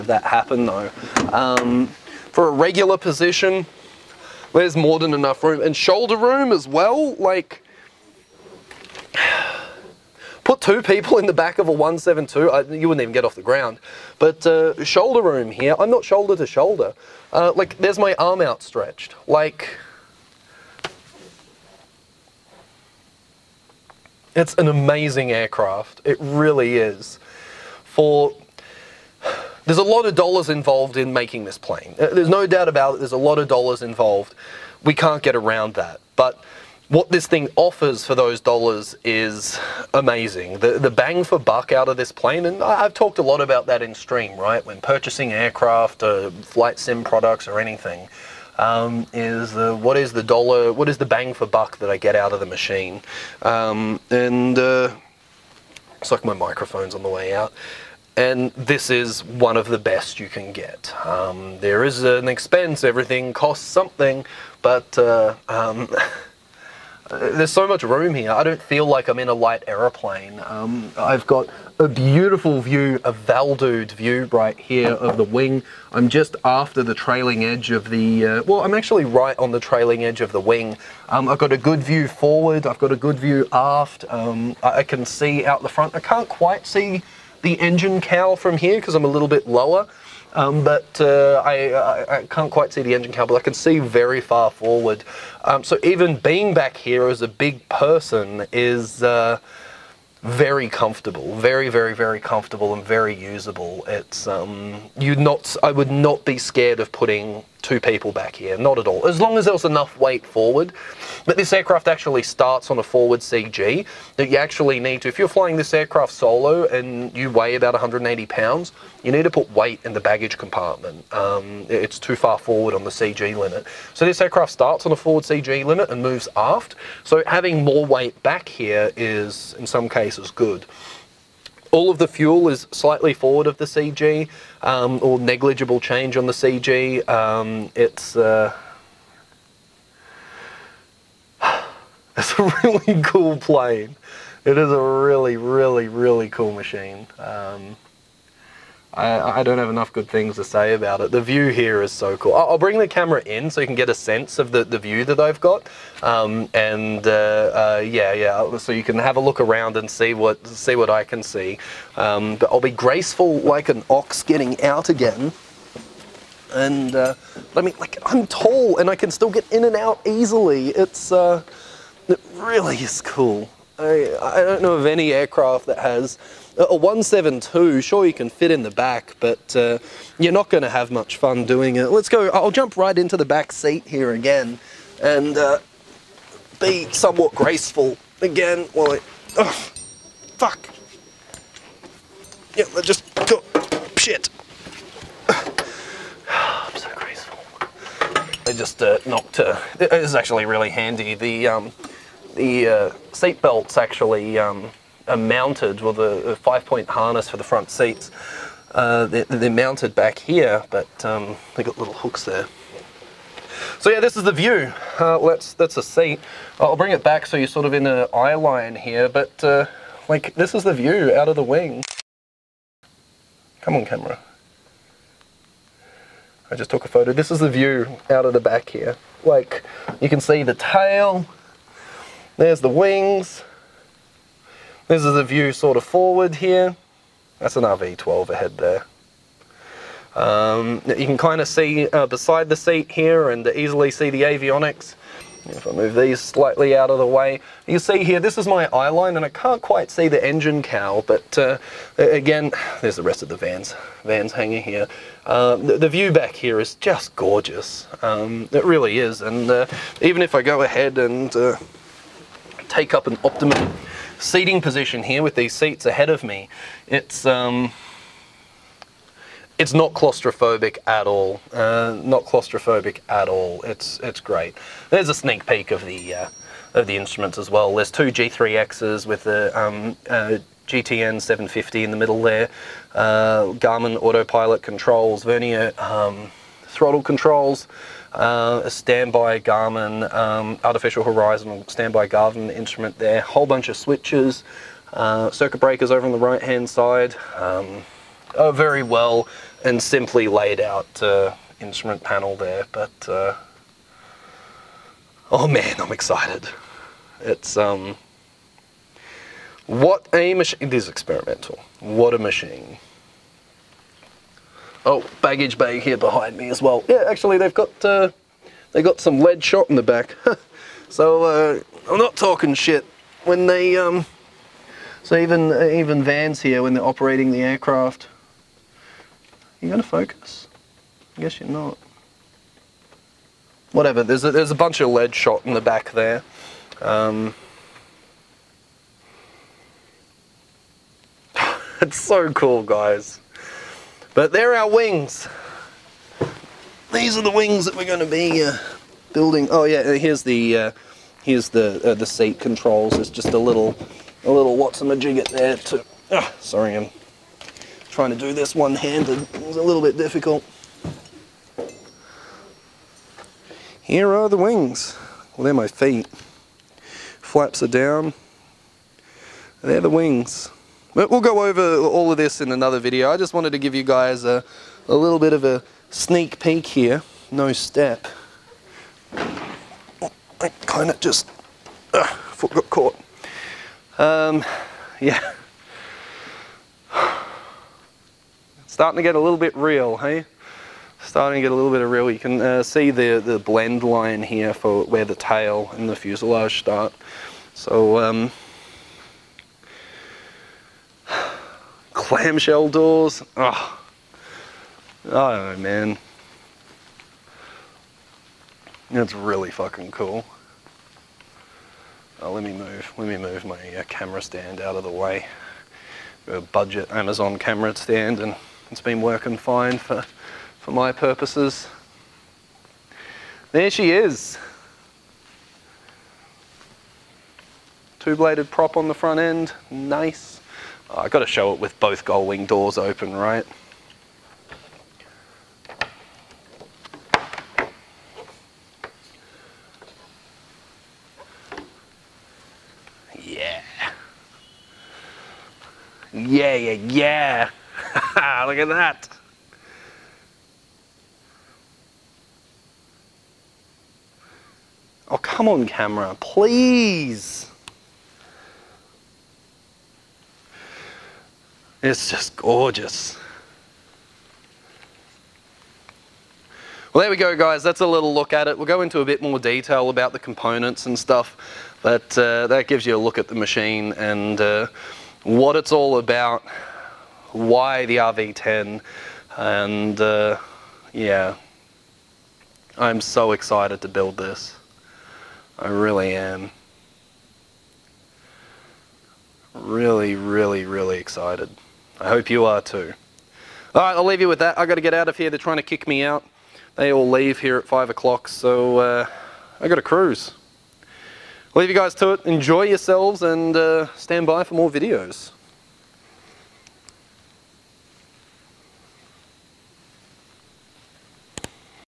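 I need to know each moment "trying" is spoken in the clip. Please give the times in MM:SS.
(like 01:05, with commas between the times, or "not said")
05:57, 08:15.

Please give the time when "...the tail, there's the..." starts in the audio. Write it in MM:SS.
03:50.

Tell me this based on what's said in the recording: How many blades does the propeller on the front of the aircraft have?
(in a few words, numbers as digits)
2.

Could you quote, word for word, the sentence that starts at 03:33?
So yeah, this is the view.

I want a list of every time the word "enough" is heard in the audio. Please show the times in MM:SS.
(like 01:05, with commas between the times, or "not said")
00:05, 01:49, 02:29.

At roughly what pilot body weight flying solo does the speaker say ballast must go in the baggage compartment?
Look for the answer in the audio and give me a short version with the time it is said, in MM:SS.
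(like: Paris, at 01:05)
180 pounds, at 01:57.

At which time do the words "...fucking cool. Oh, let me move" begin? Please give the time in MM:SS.
06:49.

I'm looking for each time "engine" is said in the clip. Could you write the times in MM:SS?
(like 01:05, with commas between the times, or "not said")
01:27, 01:32, 04:10.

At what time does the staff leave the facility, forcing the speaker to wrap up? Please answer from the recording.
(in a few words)
5 o'clock.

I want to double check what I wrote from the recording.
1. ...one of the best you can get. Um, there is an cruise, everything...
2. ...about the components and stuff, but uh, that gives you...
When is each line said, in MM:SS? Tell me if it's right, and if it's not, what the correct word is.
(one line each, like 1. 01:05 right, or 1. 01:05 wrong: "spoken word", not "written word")
1. 00:59 wrong: "expense", not "cruise"
2. 07:49 right.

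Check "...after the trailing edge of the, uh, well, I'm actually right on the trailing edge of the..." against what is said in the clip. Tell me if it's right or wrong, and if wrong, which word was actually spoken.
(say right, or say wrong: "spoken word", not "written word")
right.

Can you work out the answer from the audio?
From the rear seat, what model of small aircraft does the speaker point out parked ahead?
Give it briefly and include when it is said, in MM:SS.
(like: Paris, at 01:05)
RV12, at 03:57.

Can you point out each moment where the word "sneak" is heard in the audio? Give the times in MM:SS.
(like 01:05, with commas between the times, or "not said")
04:35, 06:15.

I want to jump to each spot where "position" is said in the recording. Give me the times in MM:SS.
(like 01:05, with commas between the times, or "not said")
00:02, 04:24.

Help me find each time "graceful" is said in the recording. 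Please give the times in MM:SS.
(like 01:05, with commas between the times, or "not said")
02:42, 03:07, 03:16.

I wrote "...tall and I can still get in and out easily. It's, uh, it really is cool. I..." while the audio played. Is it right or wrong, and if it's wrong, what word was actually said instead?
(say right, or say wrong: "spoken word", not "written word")
right.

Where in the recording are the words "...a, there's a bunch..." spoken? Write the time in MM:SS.
05:34.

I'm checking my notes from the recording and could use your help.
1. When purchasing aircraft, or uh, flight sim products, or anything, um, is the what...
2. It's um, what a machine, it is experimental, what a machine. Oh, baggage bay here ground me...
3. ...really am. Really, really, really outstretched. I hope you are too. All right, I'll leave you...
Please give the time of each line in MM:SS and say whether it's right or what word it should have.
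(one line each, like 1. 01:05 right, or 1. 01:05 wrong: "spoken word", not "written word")
1. 00:44 right
2. 05:07 wrong: "behind", not "ground"
3. 08:05 wrong: "excited", not "outstretched".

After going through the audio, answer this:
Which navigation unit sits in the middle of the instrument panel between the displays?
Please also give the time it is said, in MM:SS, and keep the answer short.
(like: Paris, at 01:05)
GTN 750, at 04:40.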